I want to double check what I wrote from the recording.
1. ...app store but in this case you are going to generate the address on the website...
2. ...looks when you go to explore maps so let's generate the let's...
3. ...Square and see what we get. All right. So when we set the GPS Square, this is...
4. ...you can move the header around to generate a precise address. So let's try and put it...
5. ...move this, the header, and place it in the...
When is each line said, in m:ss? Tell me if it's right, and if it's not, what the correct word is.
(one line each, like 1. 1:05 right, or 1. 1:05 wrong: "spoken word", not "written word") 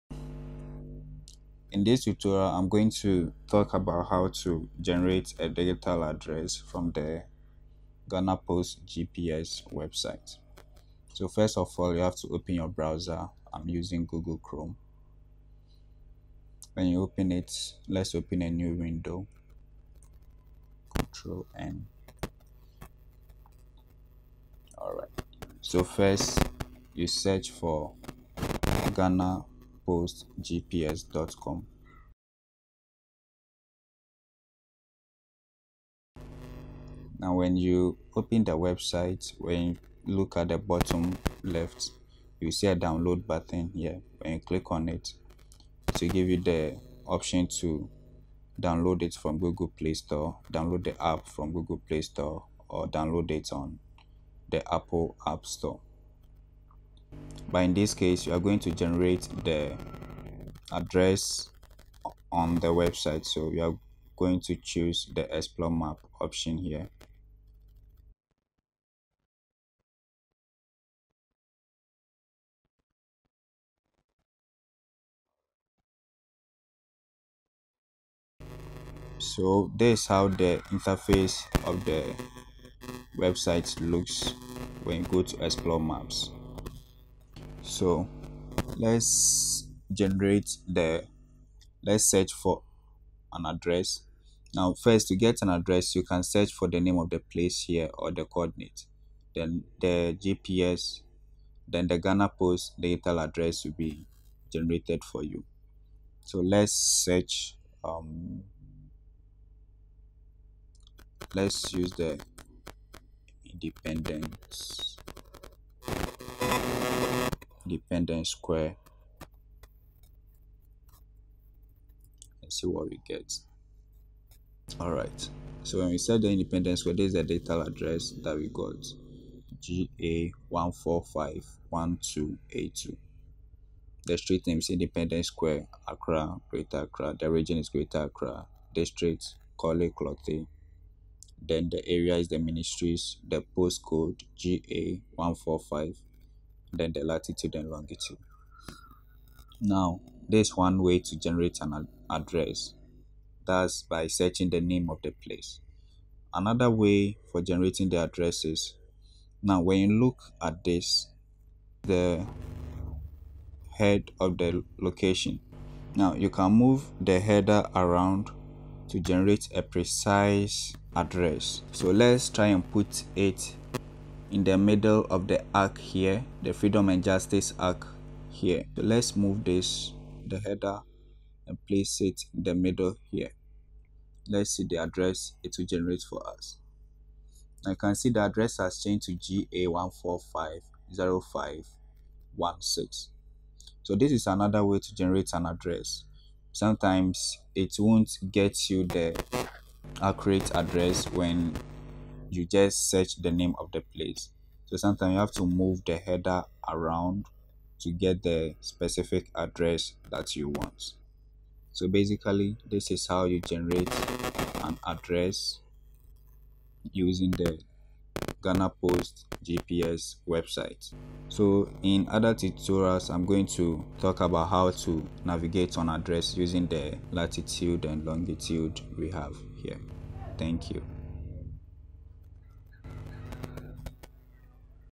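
1. 0:55 right
2. 1:23 right
3. 1:58 wrong: "Independence", not "GPS"
4. 2:46 right
5. 2:59 right.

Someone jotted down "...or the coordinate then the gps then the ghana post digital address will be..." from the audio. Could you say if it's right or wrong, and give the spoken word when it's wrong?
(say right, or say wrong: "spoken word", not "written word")
right.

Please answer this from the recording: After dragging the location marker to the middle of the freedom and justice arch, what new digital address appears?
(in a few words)
GA1450516.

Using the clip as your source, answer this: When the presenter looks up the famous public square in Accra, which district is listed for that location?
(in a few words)
Korle Klottey.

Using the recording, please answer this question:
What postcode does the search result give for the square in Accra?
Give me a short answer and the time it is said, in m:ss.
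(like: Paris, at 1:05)
GA145, at 2:24.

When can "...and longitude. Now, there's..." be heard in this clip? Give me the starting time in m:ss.
2:27.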